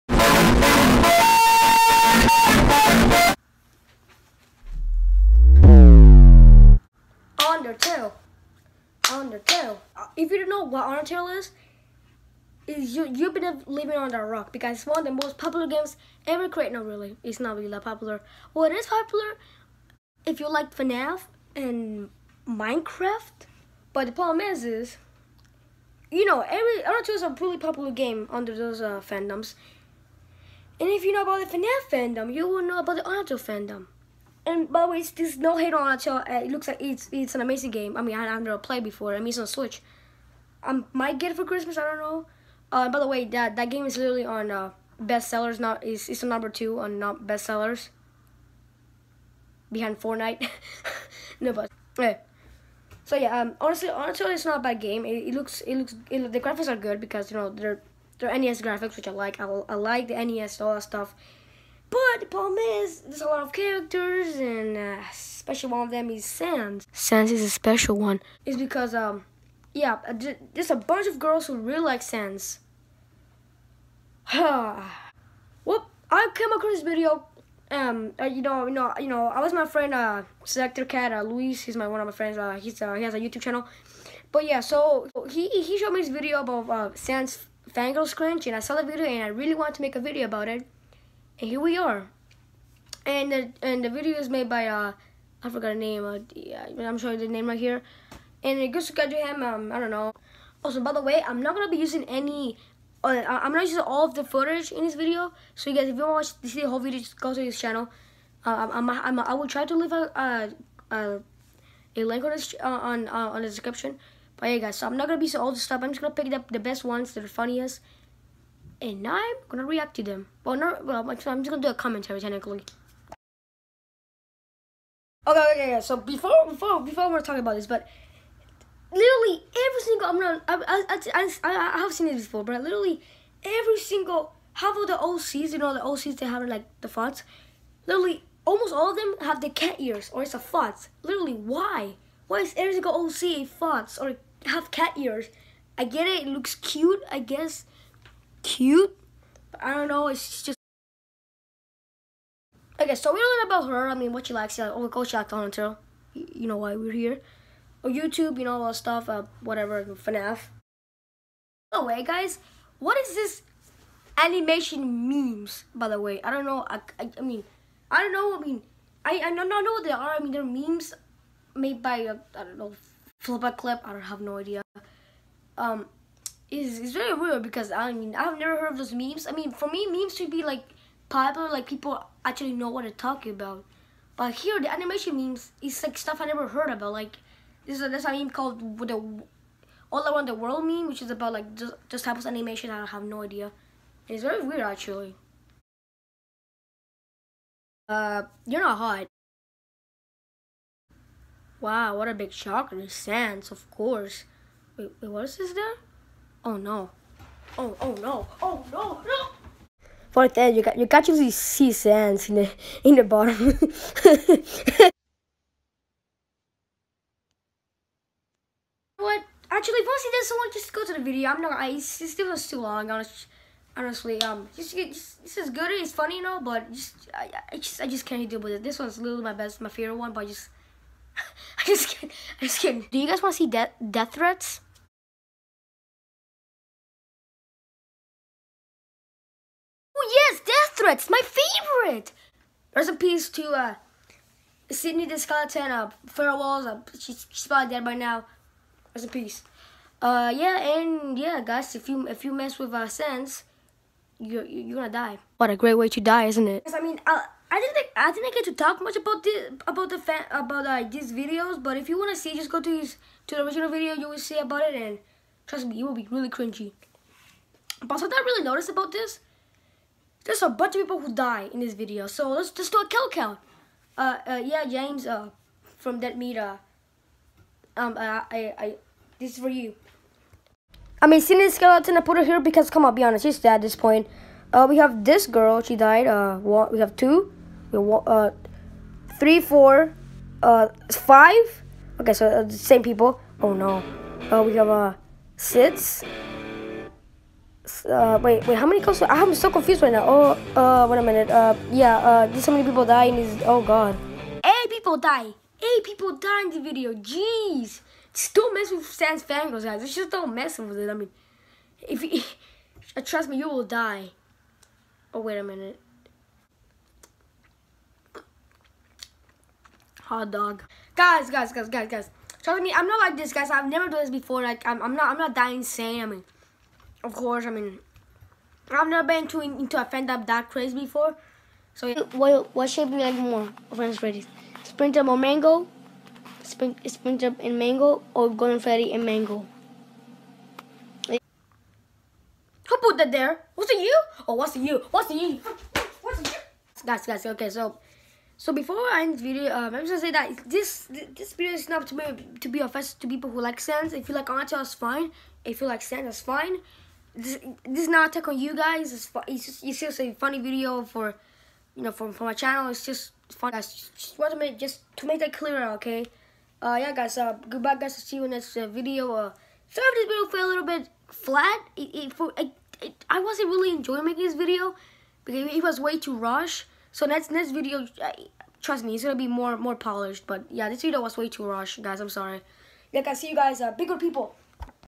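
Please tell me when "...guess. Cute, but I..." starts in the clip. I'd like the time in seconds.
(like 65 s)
147 s.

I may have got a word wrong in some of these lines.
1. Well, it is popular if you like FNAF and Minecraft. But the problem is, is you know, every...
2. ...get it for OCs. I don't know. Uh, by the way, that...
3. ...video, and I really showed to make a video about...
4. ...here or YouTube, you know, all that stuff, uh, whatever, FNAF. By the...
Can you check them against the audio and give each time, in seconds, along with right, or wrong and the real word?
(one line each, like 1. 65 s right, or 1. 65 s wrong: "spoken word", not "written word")
1. 18 s right
2. 41 s wrong: "Christmas", not "OCs"
3. 88 s wrong: "wanted", not "showed"
4. 156 s right.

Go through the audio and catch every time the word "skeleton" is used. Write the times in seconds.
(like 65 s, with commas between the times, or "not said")
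245 s, 281 s.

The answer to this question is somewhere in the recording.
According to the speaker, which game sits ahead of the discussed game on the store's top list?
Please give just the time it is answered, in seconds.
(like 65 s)
49 s.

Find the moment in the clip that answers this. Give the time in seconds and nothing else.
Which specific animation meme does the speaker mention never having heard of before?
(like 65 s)
189 s.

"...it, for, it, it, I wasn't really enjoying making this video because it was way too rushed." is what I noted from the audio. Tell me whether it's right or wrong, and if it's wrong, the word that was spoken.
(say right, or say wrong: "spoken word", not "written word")
right.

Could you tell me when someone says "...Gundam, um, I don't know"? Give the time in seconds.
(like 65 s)
98 s.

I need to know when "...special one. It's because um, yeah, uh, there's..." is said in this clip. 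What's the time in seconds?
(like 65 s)
67 s.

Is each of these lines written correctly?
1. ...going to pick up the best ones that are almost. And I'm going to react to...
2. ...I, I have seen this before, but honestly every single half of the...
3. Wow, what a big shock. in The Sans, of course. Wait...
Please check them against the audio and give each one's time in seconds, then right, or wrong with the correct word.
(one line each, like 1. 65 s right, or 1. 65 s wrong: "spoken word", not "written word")
1. 116 s wrong: "funniest", not "almost"
2. 131 s wrong: "literally", not "honestly"
3. 201 s right.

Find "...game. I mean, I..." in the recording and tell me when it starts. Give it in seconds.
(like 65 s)
37 s.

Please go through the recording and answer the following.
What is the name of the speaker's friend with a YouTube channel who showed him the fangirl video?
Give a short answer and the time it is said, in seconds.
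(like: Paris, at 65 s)
Luis, at 81 s.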